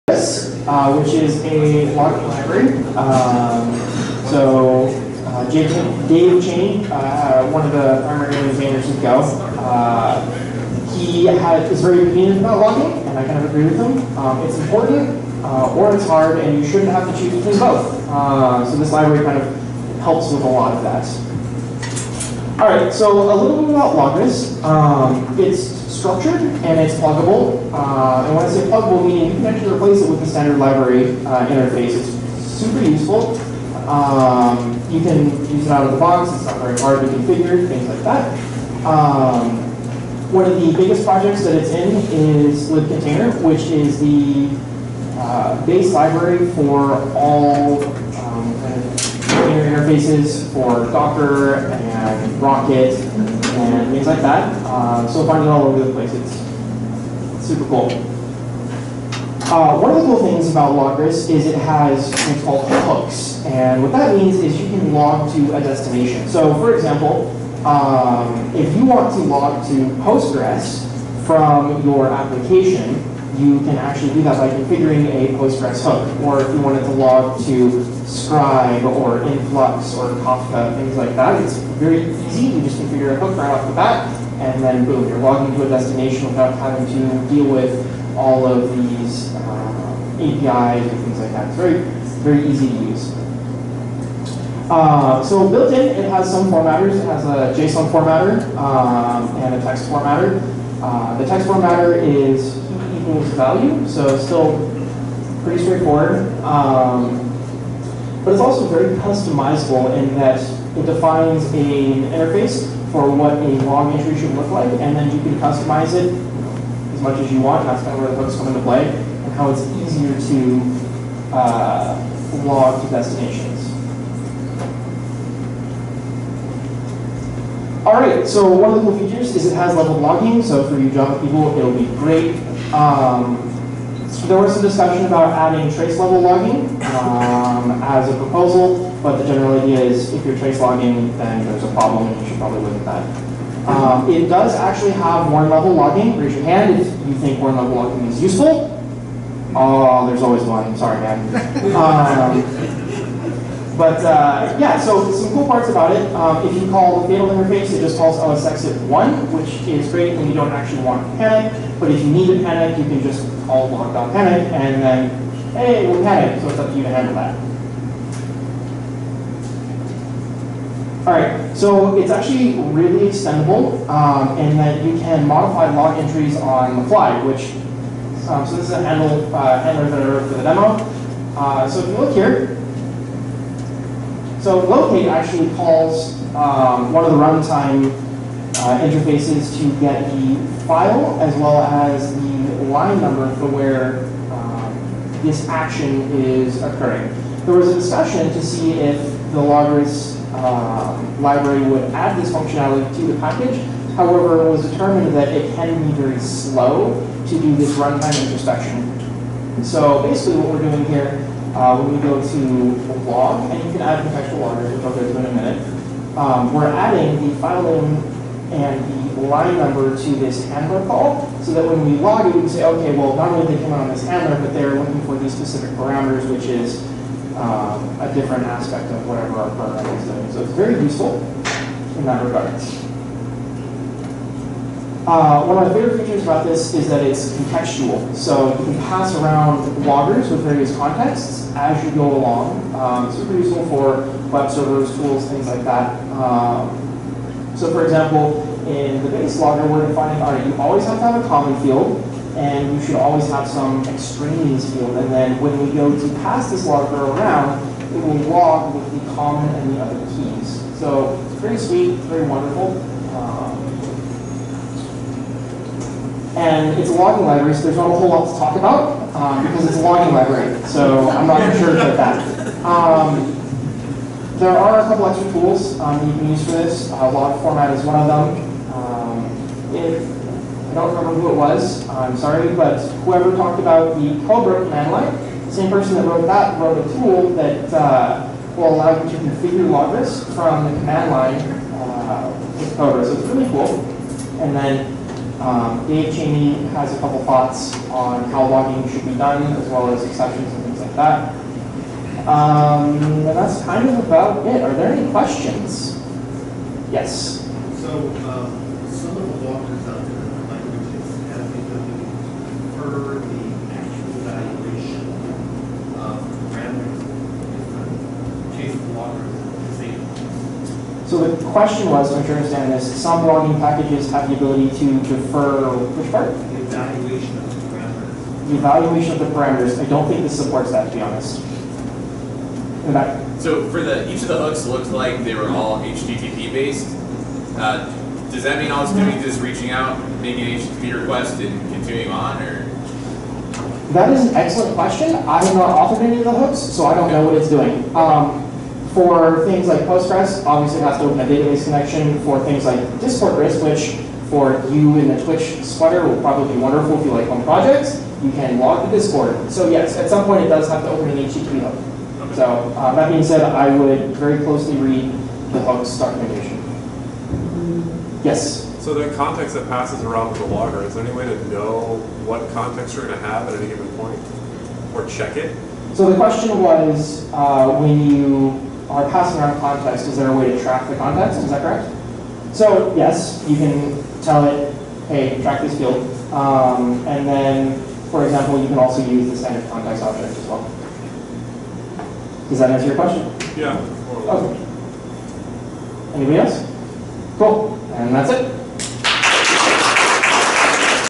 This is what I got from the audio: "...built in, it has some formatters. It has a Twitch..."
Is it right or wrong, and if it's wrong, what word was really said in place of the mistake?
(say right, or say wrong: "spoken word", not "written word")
wrong: "JSON", not "Twitch".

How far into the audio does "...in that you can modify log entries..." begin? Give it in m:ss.
2:54.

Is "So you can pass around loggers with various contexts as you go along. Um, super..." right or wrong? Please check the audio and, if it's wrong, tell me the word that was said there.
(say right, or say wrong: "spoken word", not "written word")
right.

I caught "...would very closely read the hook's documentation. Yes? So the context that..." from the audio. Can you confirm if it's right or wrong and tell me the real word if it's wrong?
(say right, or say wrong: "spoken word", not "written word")
right.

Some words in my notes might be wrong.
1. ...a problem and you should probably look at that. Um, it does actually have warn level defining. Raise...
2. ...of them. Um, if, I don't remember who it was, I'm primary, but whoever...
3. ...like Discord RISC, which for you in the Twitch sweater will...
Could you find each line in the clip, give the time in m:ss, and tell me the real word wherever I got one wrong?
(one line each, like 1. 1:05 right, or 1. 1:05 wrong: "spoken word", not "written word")
1. 2:21 wrong: "logging", not "defining"
2. 4:37 wrong: "sorry", not "primary"
3. 5:52 right.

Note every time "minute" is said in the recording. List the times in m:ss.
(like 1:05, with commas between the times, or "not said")
3:35.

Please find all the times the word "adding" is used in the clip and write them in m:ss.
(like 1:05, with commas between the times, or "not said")
2:15, 3:36.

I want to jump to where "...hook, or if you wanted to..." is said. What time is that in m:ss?
1:15.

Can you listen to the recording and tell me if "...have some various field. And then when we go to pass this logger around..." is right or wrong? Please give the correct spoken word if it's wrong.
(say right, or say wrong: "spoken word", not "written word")
wrong: "extraneous", not "various".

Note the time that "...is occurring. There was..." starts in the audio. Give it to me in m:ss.
3:16.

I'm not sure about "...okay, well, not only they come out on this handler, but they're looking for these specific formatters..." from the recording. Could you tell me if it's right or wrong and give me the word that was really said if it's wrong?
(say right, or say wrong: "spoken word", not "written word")
wrong: "parameters", not "formatters".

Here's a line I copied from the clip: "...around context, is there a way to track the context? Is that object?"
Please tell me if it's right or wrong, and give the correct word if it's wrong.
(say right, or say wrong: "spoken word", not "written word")
wrong: "correct", not "object".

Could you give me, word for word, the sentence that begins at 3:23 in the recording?
However, it was determined that it can be very slow to do this runtime introspection.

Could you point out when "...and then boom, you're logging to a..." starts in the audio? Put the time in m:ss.
1:24.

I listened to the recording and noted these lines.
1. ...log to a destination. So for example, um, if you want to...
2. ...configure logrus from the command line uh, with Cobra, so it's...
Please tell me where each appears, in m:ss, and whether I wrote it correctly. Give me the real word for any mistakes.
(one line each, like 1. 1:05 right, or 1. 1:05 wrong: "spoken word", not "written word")
1. 1:04 right
2. 4:49 right.